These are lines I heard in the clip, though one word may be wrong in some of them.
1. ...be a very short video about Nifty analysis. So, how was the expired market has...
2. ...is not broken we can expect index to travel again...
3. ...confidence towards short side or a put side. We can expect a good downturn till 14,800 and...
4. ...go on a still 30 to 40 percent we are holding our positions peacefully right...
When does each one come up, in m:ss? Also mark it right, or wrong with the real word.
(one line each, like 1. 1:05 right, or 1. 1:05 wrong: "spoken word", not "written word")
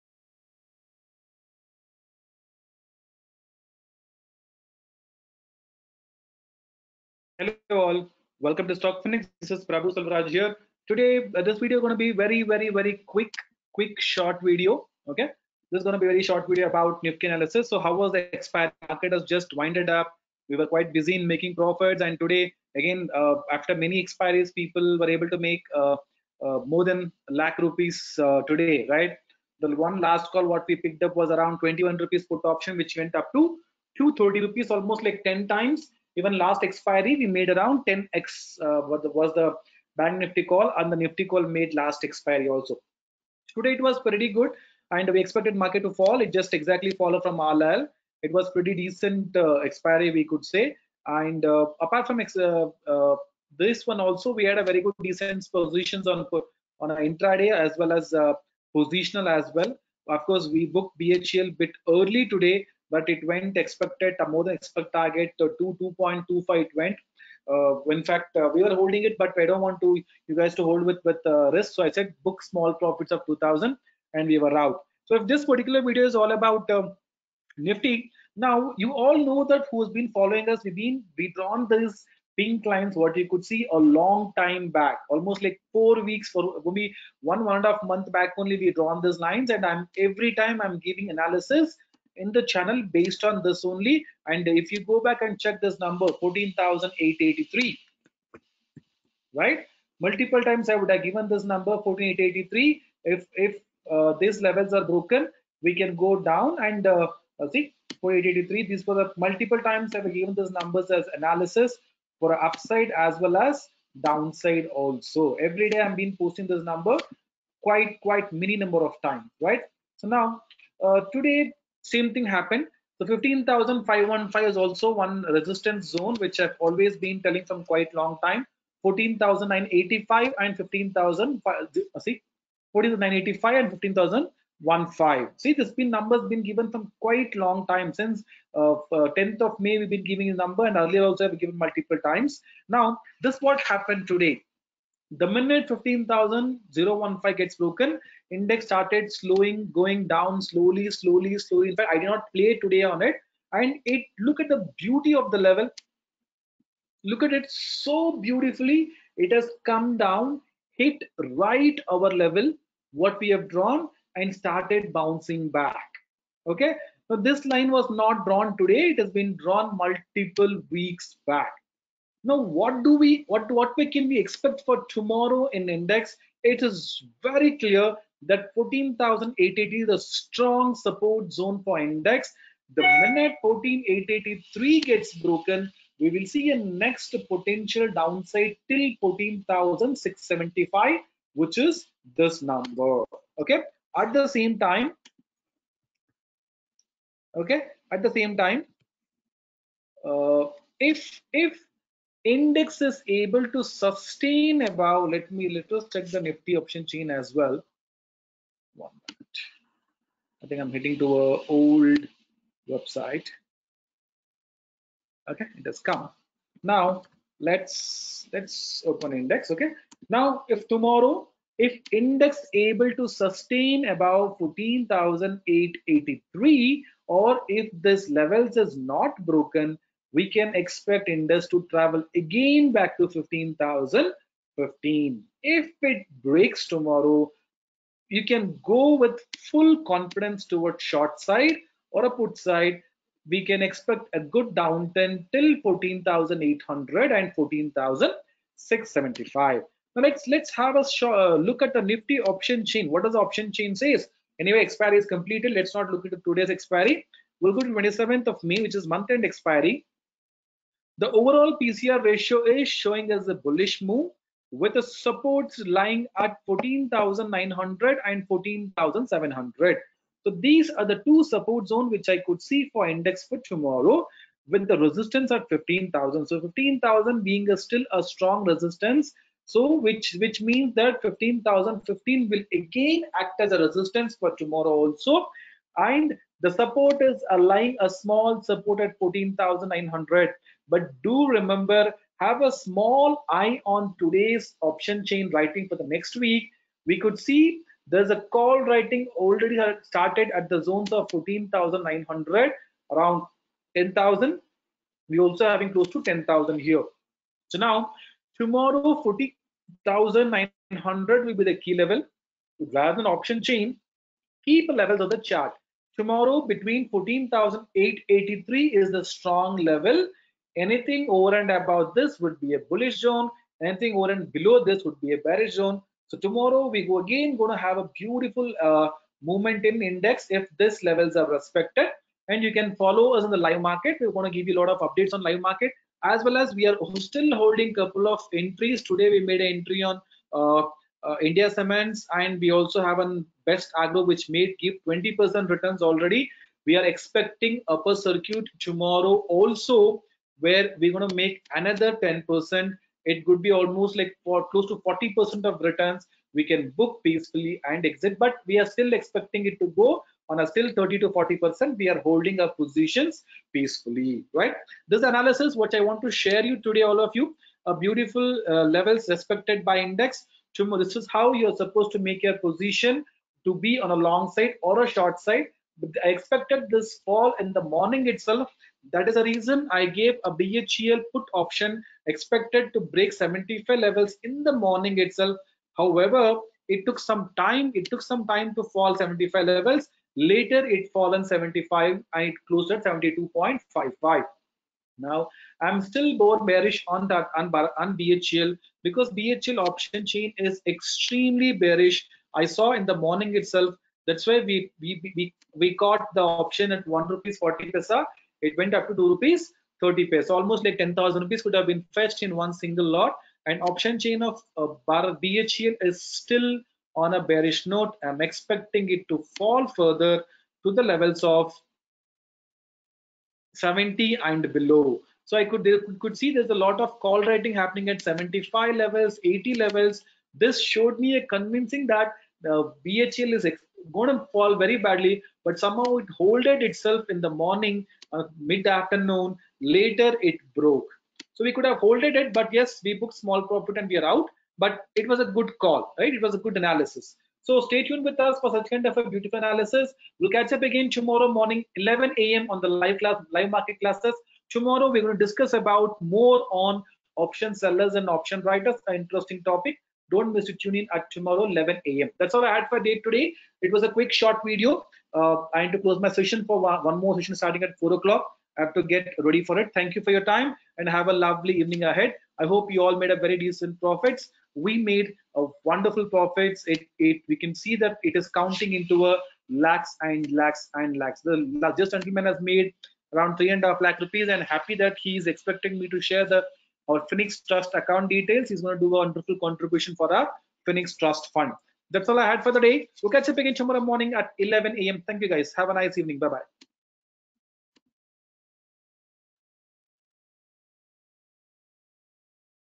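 1. 0:15 right
2. 3:48 right
3. 3:59 right
4. 5:59 right.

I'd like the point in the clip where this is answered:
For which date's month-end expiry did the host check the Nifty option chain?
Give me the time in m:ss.
4:17.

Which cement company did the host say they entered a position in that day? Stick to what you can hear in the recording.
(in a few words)
India Cements.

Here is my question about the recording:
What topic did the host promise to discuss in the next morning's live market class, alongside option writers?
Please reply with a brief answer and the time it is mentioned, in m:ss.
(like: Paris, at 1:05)
option sellers, at 7:37.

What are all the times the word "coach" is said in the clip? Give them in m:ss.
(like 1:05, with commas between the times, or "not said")
not said.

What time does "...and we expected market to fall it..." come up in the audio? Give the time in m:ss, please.
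0:44.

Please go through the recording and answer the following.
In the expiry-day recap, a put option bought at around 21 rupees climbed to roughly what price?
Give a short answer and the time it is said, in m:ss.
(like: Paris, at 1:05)
230 rupees, at 0:34.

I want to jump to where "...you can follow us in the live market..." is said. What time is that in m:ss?
5:32.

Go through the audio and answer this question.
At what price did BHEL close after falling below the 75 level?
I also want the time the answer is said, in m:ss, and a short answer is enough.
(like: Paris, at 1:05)
72.55, at 6:32.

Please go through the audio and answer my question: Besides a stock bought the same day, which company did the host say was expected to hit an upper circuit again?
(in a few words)
Best Agro.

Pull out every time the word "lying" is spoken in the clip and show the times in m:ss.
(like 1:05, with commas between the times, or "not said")
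4:25, 4:47.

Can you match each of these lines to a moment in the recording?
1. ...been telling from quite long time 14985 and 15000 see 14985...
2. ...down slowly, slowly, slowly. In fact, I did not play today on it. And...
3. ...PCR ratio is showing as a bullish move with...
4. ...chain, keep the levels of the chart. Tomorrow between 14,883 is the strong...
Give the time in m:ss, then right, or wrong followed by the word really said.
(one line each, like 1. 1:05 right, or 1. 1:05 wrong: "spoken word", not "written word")
1. 2:06 right
2. 2:30 right
3. 4:21 right
4. 5:13 right.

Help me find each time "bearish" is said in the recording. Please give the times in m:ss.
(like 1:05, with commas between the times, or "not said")
5:25, 6:36, 6:41, 6:57.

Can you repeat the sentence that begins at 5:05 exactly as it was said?
We also having close to 10,000 here.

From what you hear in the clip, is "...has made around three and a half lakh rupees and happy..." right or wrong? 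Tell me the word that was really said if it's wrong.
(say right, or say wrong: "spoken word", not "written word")
right.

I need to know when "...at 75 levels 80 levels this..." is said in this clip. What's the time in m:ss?
7:07.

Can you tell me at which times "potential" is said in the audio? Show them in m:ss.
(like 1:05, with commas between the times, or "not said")
3:07.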